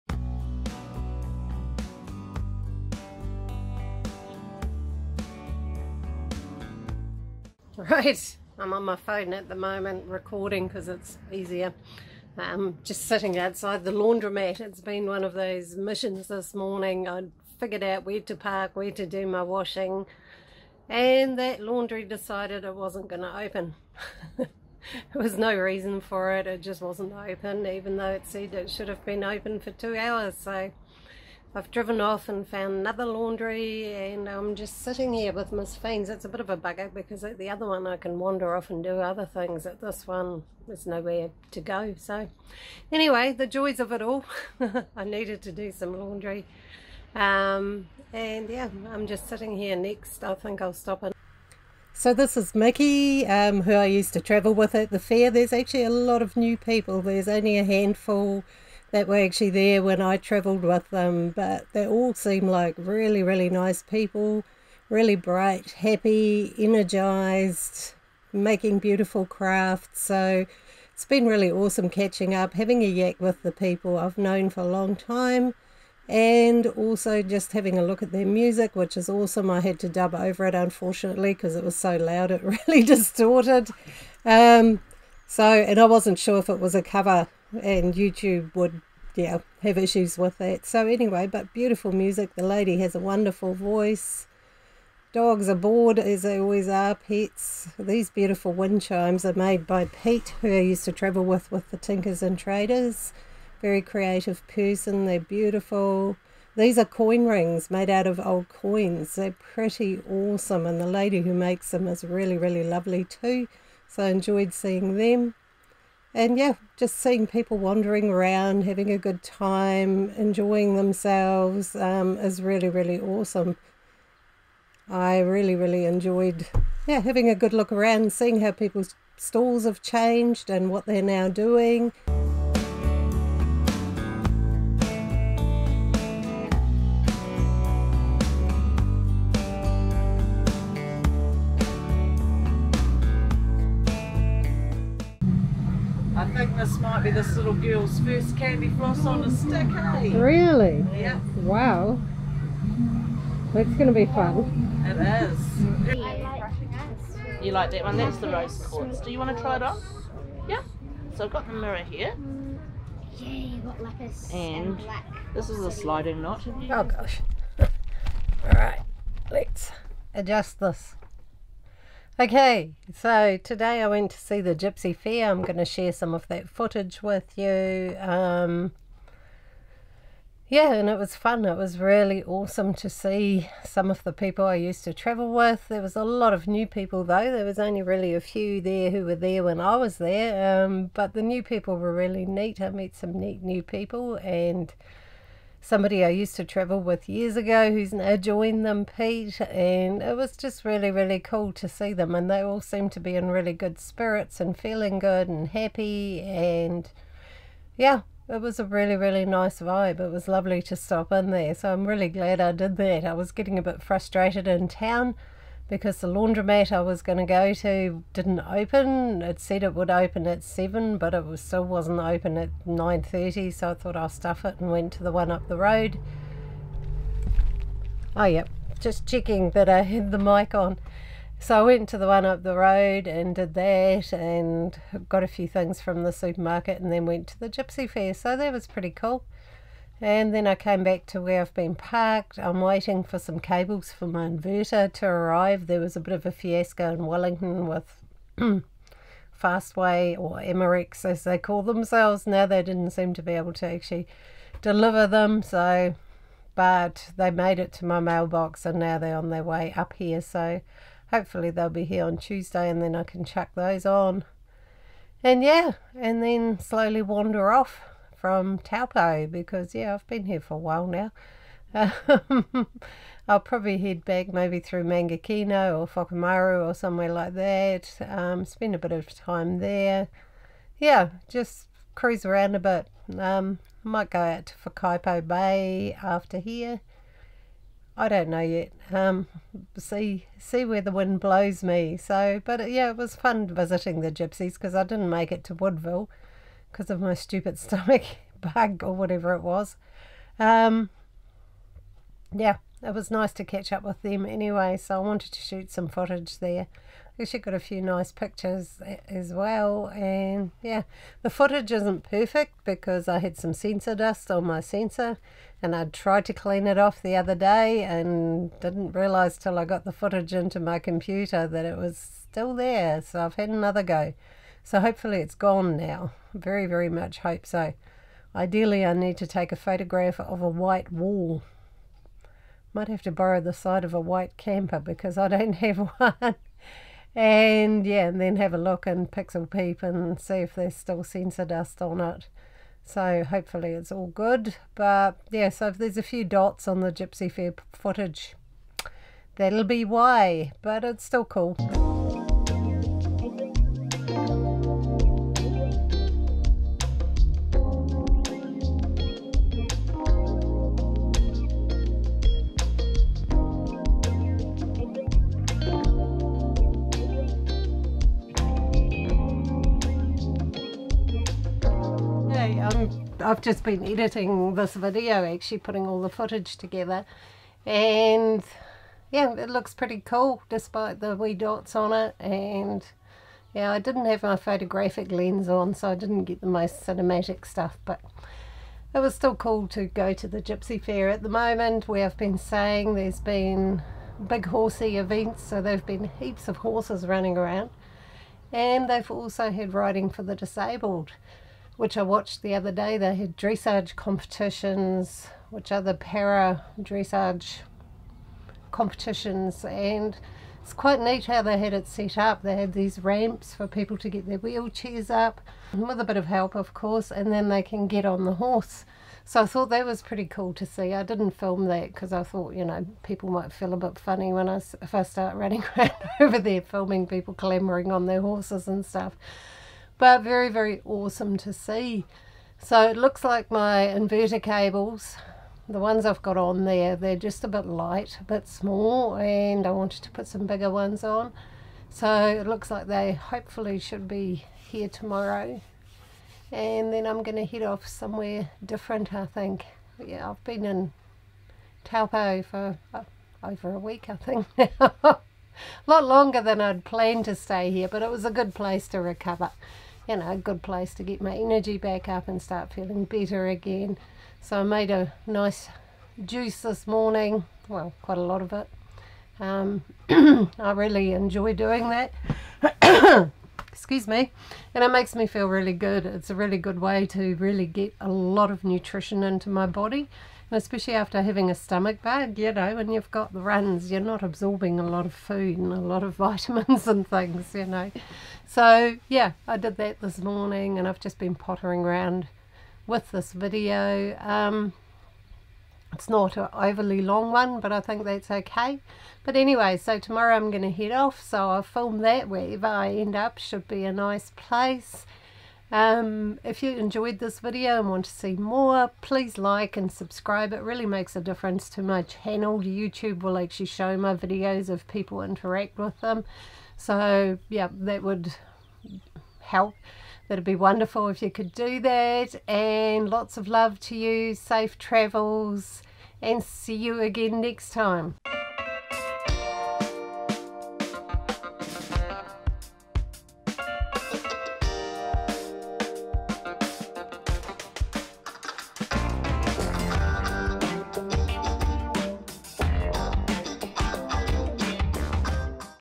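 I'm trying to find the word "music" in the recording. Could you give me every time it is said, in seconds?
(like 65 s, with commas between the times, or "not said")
78 s, 91 s.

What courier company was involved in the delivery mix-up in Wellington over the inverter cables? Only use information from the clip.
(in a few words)
Fastway.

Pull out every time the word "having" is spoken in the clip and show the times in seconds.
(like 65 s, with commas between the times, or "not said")
72 s, 77 s, 118 s, 126 s, 481 s.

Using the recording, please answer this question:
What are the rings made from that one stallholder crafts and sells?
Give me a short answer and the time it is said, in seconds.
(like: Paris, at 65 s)
Old coins, at 108 s.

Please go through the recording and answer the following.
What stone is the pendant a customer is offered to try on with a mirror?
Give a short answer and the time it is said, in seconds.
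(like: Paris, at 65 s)
Rose quartz, at 158 s.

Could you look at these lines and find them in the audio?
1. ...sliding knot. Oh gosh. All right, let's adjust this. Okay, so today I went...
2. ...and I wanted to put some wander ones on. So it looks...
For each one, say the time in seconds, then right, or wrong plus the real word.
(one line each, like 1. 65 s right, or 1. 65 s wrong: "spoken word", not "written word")
1. 165 s right
2. 439 s wrong: "bigger", not "wander".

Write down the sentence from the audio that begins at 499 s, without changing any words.
But anyway, so tomorrow I'm going to head off, so I'll film that wherever I end up.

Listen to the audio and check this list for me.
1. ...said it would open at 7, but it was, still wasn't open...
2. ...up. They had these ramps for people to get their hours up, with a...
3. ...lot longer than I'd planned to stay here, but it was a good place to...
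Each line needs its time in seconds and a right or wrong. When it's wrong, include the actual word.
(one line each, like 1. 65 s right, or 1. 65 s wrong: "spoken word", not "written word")
1. 219 s right
2. 412 s wrong: "wheelchairs", not "hours"
3. 455 s right.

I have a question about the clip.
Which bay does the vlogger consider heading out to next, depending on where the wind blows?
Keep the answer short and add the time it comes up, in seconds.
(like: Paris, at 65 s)
Whakaipo Bay, at 284 s.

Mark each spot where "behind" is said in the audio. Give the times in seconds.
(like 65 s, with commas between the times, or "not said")
not said.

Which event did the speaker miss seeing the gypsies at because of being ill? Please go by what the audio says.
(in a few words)
Woodville.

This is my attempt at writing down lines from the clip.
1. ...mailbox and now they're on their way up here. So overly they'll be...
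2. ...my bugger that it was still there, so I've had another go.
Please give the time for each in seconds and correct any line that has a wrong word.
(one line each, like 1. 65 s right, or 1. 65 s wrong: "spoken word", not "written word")
1. 257 s wrong: "hopefully", not "overly"
2. 320 s wrong: "computer", not "bugger".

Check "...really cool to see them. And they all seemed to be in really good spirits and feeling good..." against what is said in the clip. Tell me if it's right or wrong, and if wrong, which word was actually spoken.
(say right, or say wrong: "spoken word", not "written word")
right.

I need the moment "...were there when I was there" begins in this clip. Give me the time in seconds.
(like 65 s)
189 s.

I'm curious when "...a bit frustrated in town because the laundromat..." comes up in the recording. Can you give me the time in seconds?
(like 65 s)
213 s.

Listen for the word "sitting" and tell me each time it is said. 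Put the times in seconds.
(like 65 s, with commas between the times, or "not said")
13 s, 34 s, 49 s.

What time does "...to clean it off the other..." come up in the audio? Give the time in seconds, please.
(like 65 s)
316 s.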